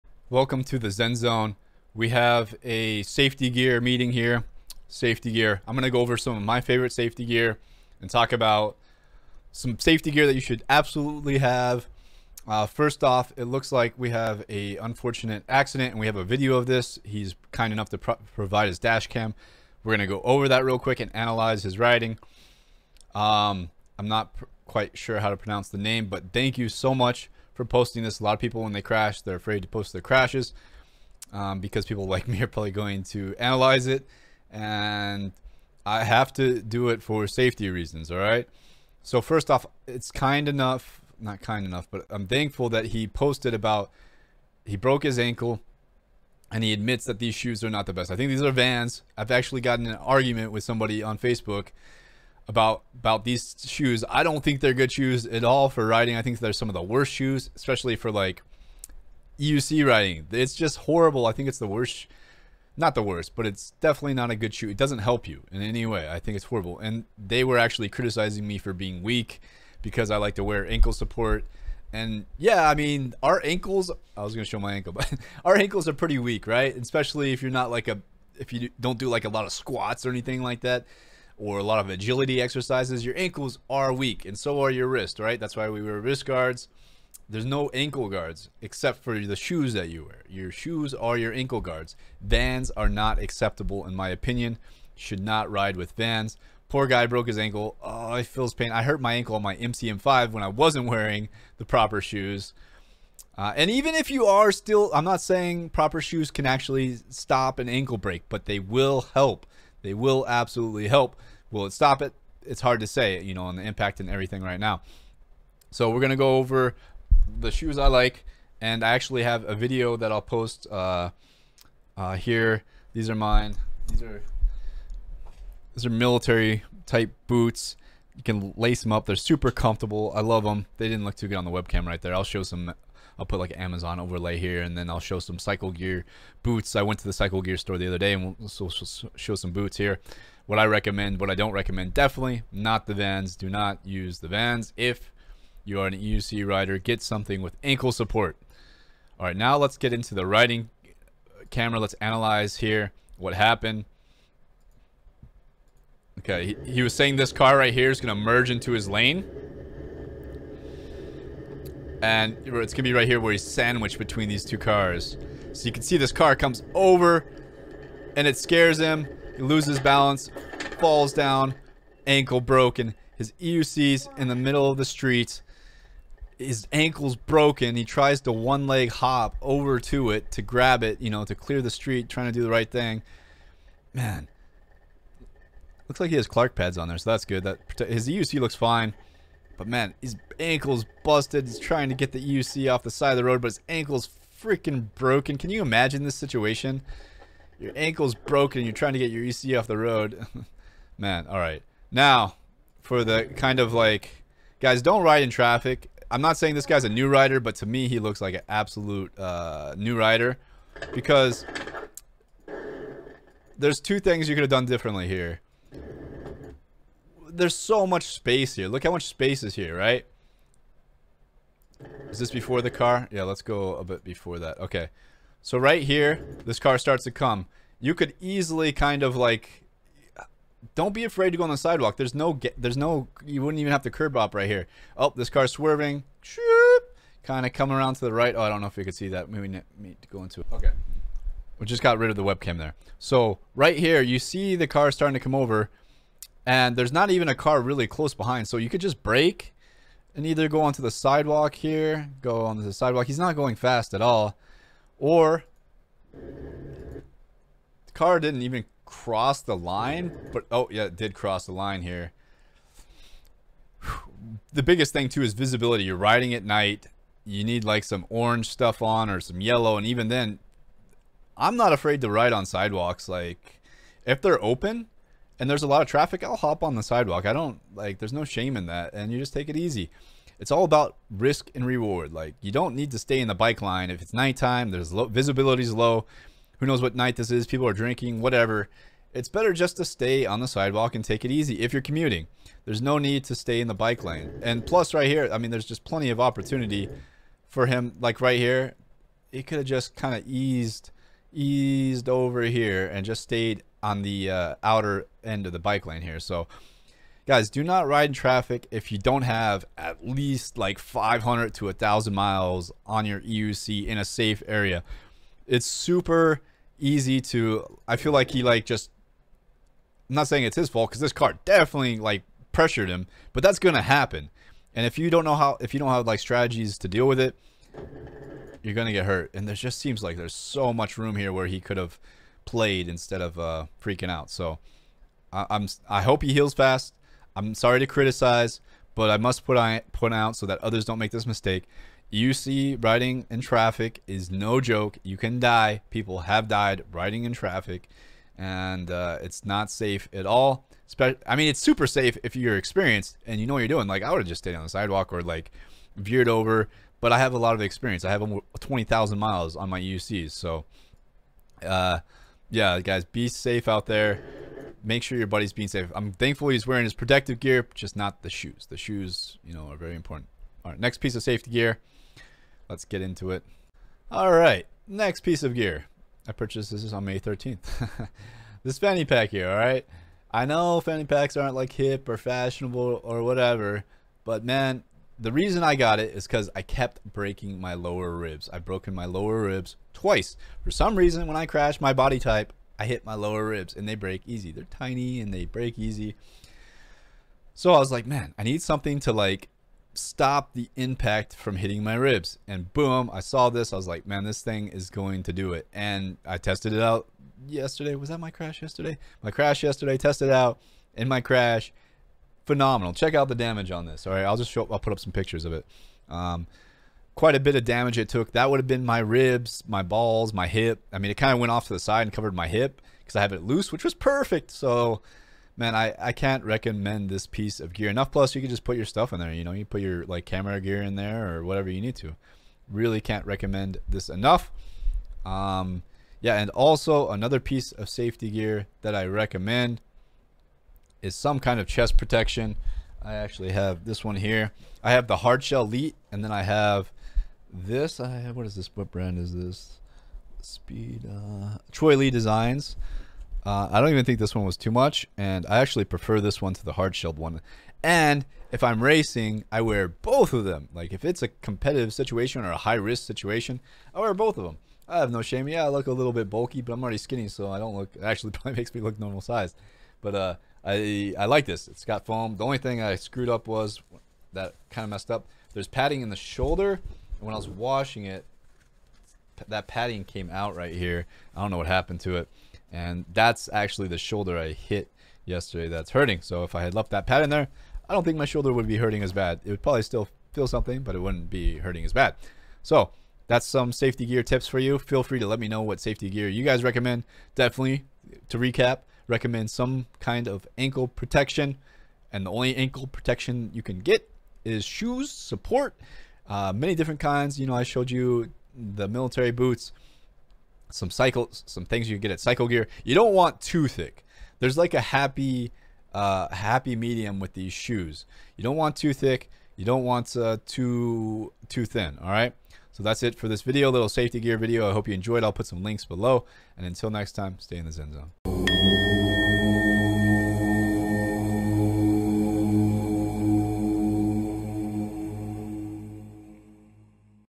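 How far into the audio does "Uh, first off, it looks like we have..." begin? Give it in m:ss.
0:12.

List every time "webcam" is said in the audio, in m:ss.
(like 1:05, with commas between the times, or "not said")
2:11, 4:02.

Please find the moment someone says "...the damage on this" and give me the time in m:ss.
6:53.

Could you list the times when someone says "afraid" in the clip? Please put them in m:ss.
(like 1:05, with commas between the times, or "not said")
0:29, 3:51, 4:31.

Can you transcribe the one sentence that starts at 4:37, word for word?
I don't like, there's no shame in that.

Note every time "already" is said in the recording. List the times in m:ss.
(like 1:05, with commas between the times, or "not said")
7:46.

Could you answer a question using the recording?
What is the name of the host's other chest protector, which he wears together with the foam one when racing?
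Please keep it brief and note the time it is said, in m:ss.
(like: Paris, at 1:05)
hardshell elite, at 7:25.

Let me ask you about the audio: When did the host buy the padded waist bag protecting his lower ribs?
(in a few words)
May 13th.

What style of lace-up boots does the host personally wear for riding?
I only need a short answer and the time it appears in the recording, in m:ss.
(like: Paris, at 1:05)
military type boots, at 2:05.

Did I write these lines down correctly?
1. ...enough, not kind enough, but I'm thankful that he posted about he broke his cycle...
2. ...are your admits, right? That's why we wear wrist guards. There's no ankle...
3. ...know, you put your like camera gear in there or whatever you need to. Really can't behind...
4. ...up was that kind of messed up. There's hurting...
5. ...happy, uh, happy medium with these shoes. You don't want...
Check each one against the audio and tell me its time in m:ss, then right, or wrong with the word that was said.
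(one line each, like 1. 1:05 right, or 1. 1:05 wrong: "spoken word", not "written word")
1. 0:40 wrong: "ankle", not "cycle"
2. 1:24 wrong: "wrists", not "admits"
3. 7:09 wrong: "recommend", not "behind"
4. 7:53 wrong: "padding", not "hurting"
5. 8:34 right.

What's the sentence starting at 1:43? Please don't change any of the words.
Uh, and even if you are still, I'm not saying proper shoes can actually stop an ankle break, but they will help.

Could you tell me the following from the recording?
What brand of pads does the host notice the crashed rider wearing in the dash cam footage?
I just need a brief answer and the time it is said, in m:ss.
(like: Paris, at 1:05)
Clark, at 3:06.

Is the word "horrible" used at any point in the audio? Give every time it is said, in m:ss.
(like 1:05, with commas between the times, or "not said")
1:00, 1:06.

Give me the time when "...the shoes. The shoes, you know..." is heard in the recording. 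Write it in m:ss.
6:08.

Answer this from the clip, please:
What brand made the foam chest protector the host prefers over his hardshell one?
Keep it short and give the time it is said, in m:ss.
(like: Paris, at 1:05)
Troy Lee Designs, at 7:31.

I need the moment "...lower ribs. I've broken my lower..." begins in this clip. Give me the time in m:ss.
6:27.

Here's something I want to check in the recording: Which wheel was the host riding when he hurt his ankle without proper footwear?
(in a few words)
MCM5.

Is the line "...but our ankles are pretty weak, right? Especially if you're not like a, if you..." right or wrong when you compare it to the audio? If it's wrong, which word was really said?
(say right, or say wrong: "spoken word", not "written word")
right.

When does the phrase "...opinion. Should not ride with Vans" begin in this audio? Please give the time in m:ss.
1:34.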